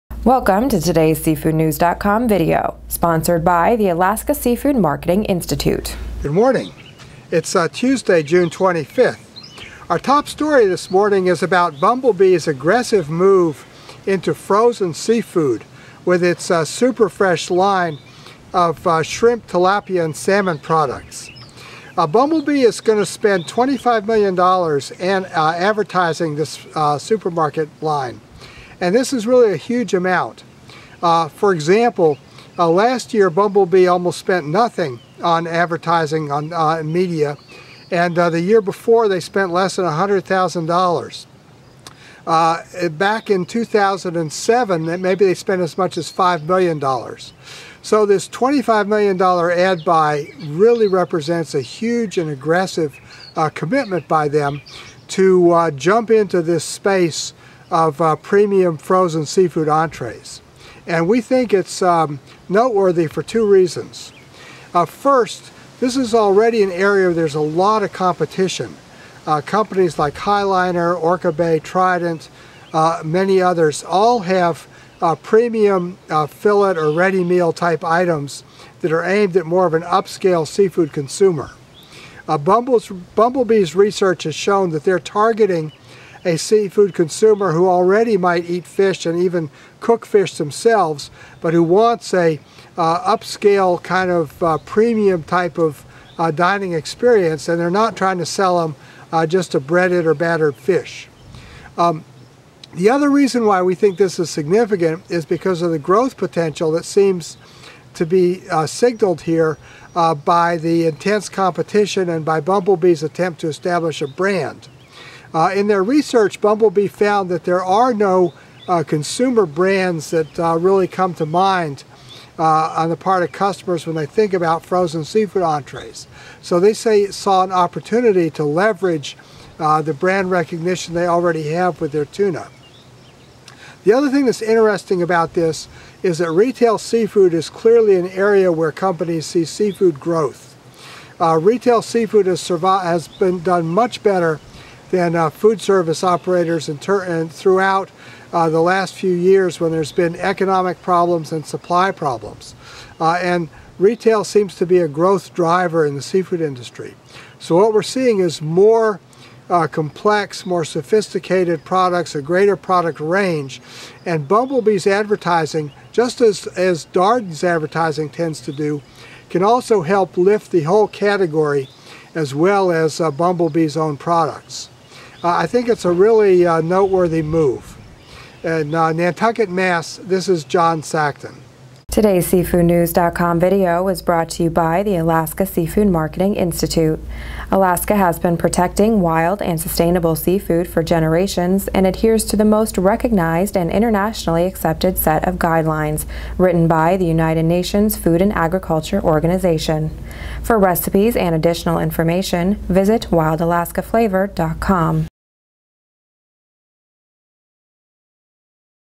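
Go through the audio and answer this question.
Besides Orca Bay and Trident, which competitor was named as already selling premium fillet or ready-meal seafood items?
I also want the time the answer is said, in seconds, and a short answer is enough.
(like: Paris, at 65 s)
High Liner, at 70 s.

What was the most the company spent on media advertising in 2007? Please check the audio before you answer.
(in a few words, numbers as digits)
$5 million.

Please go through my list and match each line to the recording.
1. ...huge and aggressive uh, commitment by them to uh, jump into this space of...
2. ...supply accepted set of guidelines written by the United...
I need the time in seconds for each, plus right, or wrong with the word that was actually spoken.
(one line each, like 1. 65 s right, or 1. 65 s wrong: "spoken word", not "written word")
1. 51 s right
2. 193 s wrong: "internationally", not "supply".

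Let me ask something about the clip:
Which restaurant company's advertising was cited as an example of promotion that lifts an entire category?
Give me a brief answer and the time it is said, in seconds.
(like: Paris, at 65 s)
Darden, at 166 s.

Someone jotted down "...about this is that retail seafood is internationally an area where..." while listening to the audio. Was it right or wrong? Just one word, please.
wrong.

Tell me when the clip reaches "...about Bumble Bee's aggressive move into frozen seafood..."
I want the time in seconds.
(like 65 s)
11 s.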